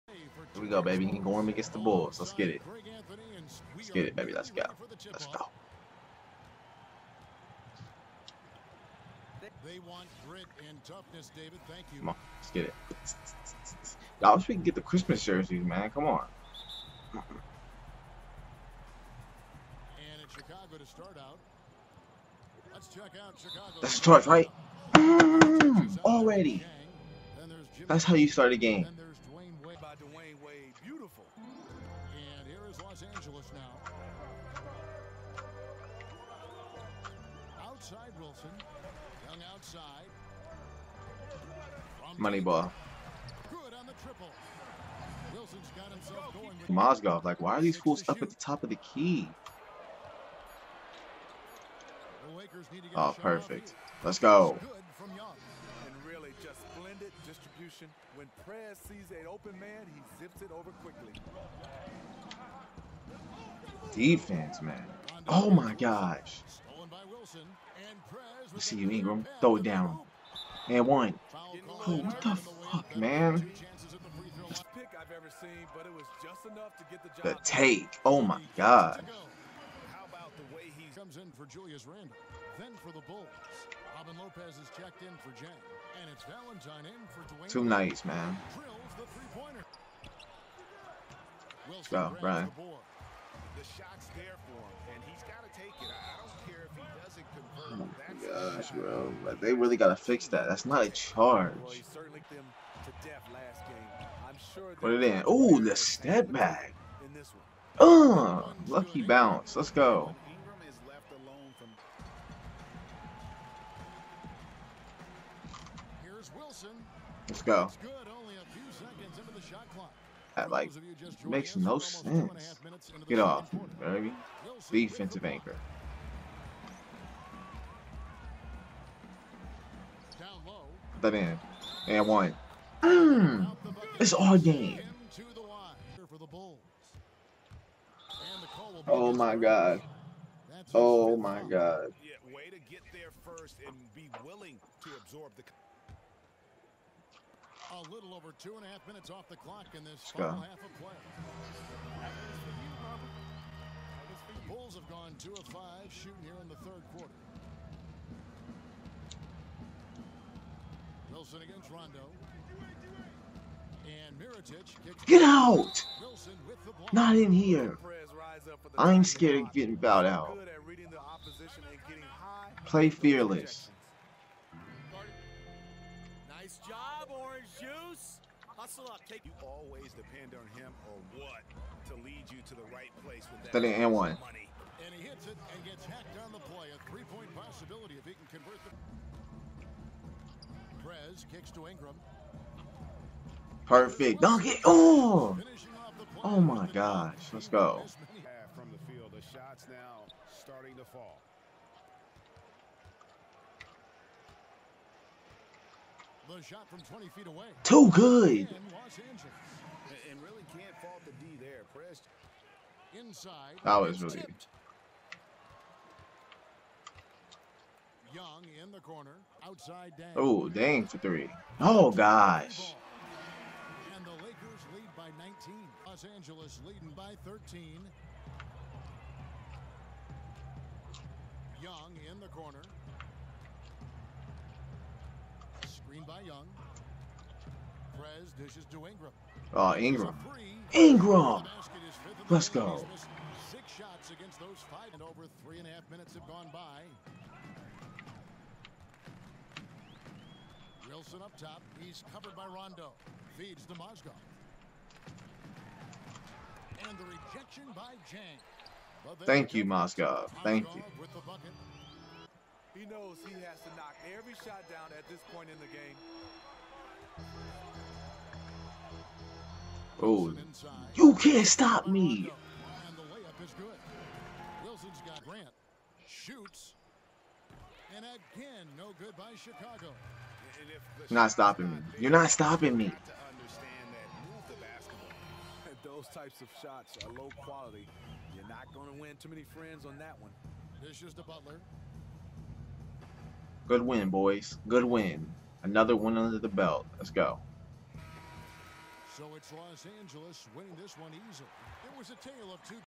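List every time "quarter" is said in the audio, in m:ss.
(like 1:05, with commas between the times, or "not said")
2:36.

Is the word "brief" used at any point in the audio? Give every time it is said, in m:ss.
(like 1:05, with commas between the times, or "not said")
not said.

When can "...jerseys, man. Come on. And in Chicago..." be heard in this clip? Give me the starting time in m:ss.
0:15.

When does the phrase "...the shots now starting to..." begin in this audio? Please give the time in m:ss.
3:19.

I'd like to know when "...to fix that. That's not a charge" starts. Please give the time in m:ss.
1:39.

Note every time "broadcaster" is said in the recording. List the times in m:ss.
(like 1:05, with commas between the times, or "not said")
not said.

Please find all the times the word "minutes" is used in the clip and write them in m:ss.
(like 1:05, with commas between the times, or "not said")
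2:28, 4:05.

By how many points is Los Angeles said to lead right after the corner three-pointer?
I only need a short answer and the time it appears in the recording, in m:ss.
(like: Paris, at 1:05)
19, at 3:45.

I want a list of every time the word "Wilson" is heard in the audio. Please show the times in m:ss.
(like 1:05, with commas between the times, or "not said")
0:38, 0:45, 2:41, 4:10.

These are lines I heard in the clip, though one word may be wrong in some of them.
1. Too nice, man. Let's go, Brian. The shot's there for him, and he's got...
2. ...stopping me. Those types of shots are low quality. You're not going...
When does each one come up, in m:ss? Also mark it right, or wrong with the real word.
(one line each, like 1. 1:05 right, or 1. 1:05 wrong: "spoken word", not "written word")
1. 1:27 right
2. 4:42 right.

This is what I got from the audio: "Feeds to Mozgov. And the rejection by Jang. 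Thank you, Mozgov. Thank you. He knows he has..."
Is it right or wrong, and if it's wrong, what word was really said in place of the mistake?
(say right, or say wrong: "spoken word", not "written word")
right.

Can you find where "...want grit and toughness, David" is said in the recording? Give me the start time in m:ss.
0:09.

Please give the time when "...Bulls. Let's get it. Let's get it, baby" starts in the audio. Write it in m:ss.
0:01.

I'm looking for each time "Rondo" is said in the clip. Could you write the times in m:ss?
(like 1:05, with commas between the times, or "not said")
2:41, 4:12.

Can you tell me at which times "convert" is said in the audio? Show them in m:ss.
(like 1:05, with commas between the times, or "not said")
1:38, 3:08.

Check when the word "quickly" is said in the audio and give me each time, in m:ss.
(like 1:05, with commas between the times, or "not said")
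1:00.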